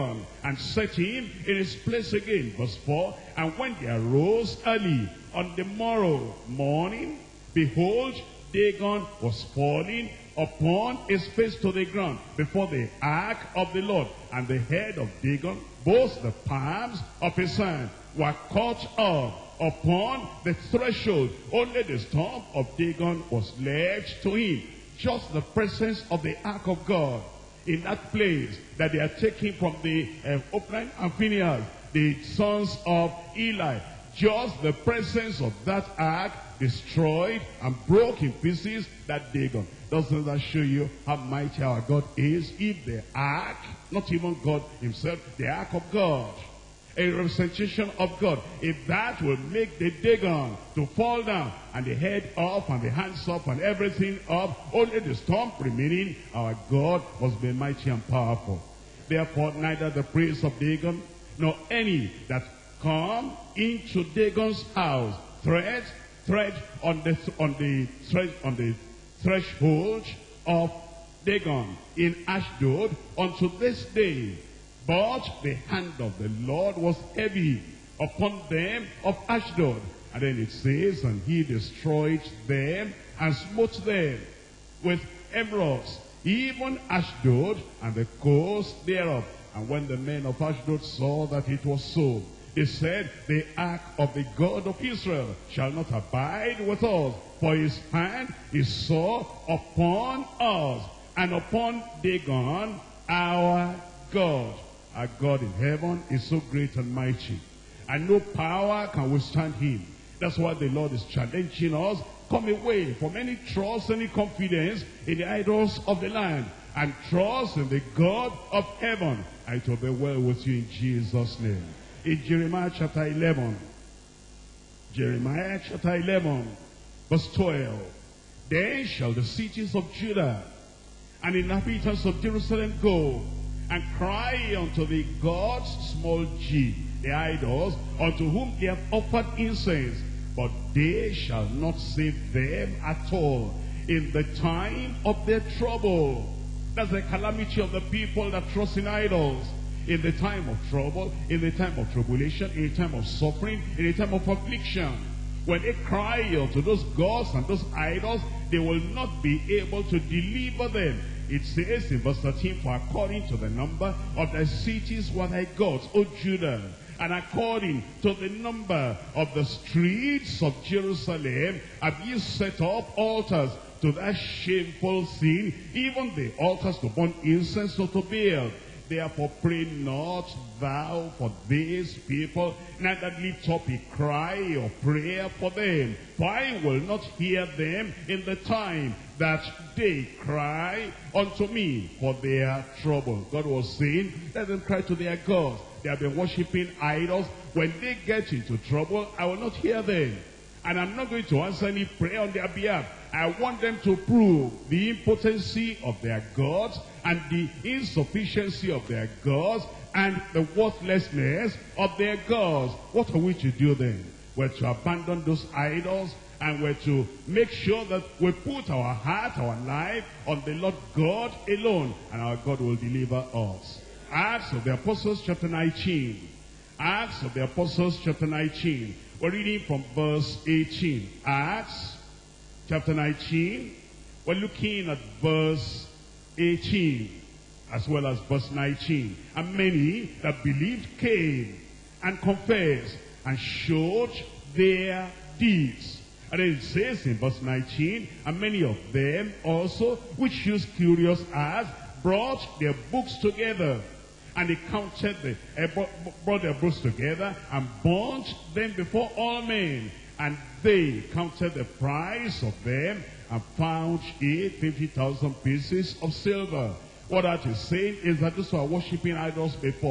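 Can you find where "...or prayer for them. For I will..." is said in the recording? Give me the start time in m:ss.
3:04.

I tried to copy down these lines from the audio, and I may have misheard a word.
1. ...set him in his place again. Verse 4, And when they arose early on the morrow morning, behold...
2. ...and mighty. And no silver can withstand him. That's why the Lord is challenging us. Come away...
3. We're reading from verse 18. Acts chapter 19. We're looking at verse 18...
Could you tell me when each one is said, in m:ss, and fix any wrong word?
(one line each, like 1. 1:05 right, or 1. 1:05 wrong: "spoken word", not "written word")
1. 0:00 right
2. 1:46 wrong: "power", not "silver"
3. 3:49 right.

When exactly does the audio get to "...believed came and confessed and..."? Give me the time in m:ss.
4:00.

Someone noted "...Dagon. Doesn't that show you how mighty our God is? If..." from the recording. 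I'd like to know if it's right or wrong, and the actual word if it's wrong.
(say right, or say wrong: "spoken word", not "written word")
right.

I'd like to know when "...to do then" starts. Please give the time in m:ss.
3:33.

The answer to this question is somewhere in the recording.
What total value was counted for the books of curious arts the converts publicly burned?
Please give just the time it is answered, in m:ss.
4:24.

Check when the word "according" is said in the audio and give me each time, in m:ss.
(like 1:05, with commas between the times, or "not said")
2:42, 2:47.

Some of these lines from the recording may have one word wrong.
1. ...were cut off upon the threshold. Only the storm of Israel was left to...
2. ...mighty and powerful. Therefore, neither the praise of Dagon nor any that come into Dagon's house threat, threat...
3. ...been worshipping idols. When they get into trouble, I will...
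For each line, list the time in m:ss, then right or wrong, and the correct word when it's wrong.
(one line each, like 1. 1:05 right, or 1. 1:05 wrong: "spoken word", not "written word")
1. 0:18 wrong: "Dagon", not "Israel"
2. 0:57 right
3. 3:16 right.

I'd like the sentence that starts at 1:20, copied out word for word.
And then it says, and he destroyed them and smote them with emerods, even Ashdod and the coast thereof.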